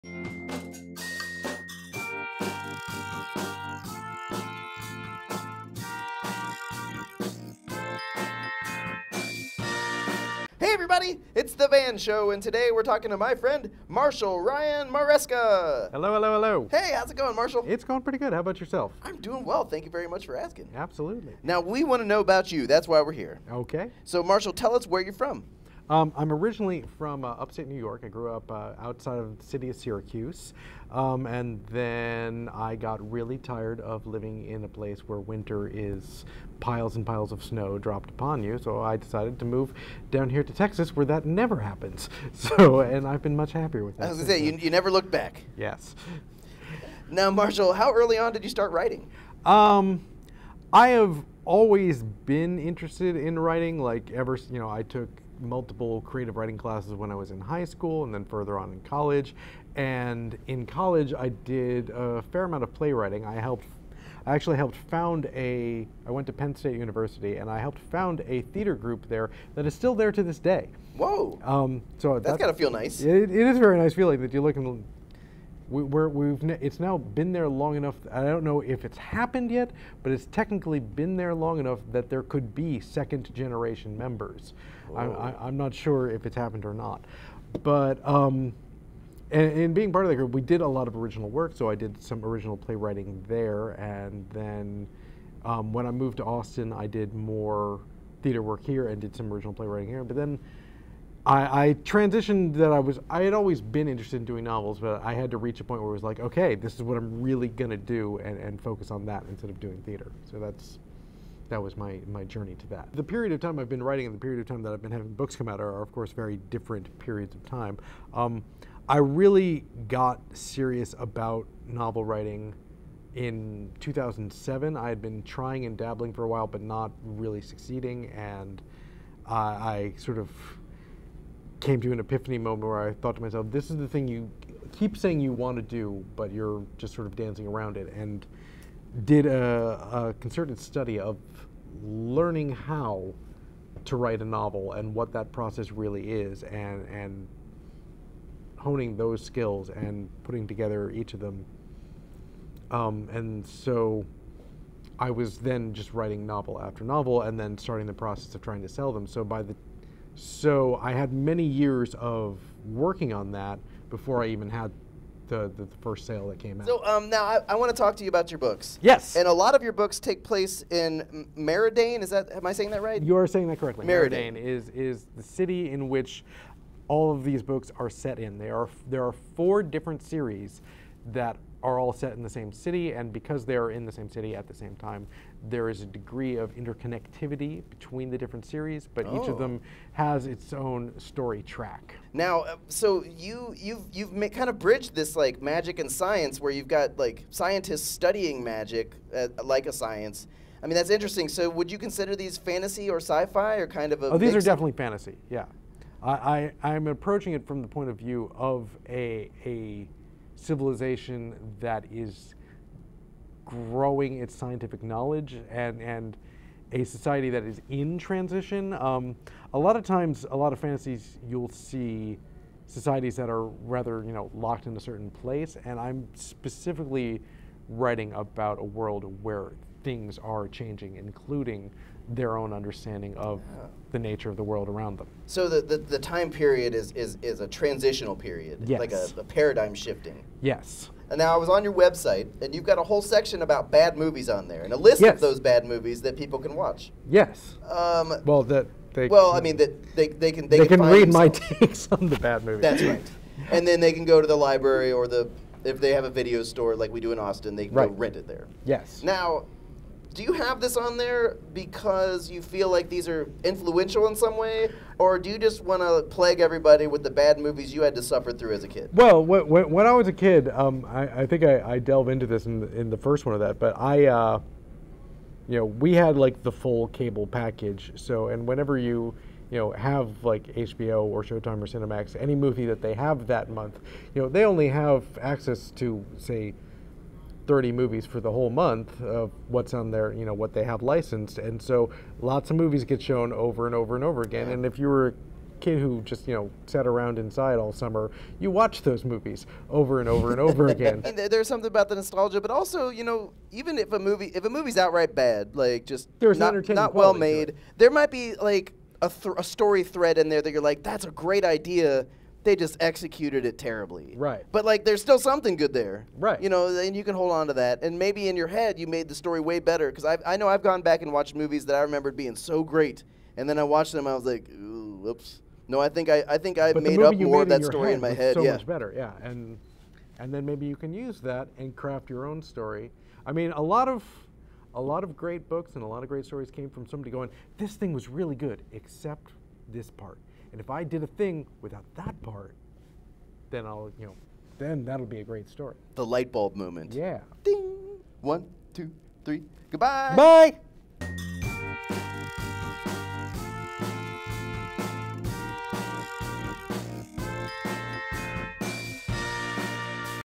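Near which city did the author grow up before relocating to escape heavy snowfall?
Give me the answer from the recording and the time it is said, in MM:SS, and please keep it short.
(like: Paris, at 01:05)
Syracuse, at 00:29.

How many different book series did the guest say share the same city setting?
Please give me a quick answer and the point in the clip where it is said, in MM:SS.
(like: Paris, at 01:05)
4, at 02:59.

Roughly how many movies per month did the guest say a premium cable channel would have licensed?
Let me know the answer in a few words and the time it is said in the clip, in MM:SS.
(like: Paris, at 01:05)
30, at 04:47.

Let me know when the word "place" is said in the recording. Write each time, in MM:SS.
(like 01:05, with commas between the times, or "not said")
00:34, 02:50, 03:45.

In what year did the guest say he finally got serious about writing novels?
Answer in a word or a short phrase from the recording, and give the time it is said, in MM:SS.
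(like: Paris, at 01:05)
2007, at 02:03.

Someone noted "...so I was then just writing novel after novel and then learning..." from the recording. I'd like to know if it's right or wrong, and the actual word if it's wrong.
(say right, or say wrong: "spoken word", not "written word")
wrong: "starting", not "learning".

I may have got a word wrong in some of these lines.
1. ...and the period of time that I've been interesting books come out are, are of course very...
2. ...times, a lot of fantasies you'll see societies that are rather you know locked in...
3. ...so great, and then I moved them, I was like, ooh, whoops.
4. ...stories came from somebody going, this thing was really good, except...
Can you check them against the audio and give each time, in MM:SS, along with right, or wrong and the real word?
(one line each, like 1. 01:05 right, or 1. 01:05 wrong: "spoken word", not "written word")
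1. 01:54 wrong: "having", not "interesting"
2. 03:39 right
3. 05:22 wrong: "watched", not "moved"
4. 05:36 right.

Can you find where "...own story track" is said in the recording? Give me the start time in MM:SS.
03:10.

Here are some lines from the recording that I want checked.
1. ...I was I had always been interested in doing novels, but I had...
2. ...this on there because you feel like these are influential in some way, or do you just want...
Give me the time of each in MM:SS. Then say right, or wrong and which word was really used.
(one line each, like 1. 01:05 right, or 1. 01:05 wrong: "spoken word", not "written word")
1. 01:42 right
2. 04:20 right.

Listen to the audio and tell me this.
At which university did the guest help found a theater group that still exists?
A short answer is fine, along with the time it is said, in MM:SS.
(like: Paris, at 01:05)
Penn State University, at 01:06.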